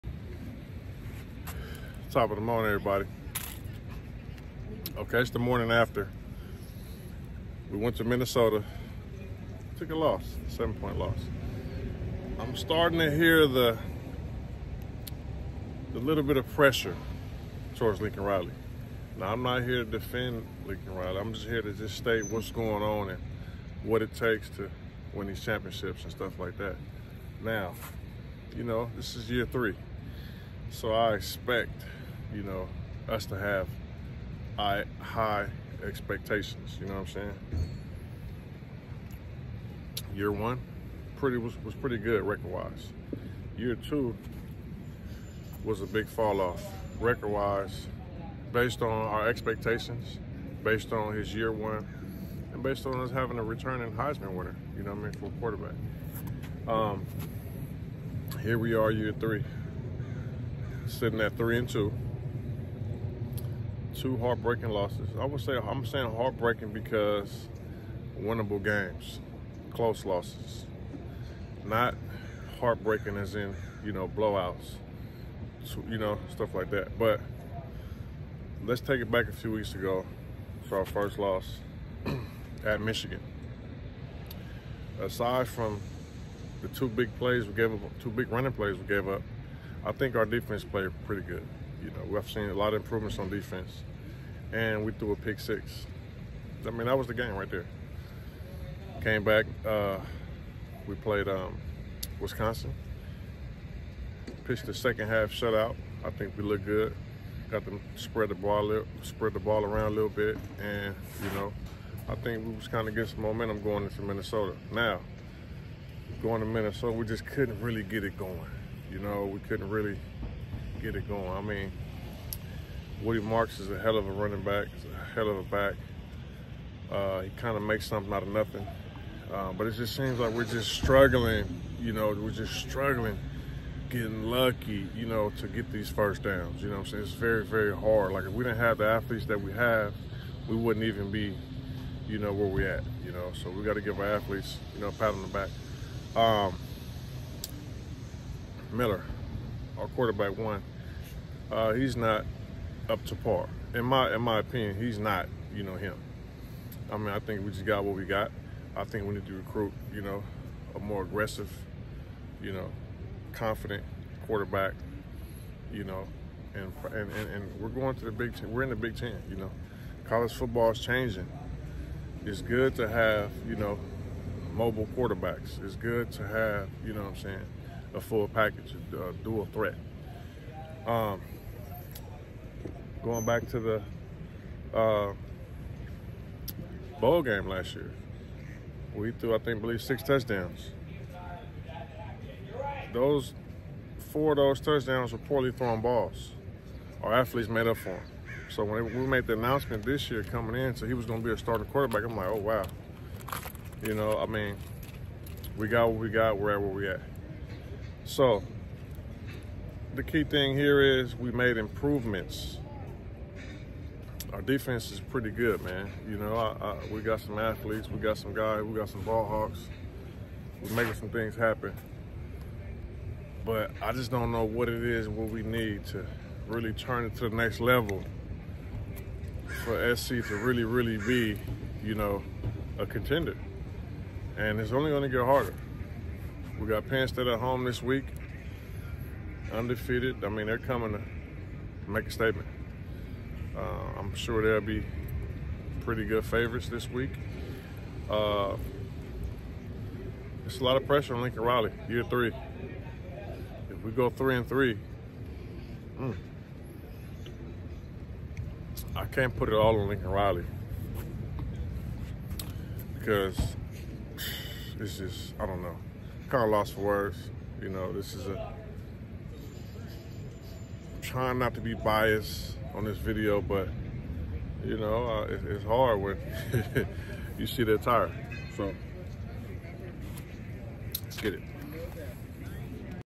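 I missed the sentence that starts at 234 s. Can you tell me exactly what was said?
And it's only going to get harder.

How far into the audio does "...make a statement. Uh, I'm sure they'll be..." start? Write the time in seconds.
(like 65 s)
241 s.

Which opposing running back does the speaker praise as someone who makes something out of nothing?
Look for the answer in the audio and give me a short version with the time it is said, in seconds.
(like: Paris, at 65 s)
Woody Marks, at 123 s.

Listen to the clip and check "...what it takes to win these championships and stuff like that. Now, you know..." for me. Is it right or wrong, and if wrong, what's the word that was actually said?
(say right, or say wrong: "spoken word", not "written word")
right.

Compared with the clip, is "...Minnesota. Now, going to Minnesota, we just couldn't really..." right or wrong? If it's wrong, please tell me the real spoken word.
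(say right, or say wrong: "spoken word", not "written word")
right.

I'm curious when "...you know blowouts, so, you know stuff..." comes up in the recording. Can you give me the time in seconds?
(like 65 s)
73 s.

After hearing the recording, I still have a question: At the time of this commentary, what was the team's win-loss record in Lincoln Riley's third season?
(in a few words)
3-2.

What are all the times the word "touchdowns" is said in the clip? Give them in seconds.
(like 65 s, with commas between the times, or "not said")
190 s, 194 s.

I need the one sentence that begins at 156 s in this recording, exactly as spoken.
I mean, I think we just got what we got.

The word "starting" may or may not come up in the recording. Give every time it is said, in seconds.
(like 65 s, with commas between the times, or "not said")
12 s, 201 s.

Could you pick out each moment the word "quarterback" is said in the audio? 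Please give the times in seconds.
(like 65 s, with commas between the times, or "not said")
55 s, 149 s, 164 s, 174 s, 201 s.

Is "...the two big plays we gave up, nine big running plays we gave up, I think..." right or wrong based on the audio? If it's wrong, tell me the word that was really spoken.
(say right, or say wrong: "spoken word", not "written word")
wrong: "two", not "nine".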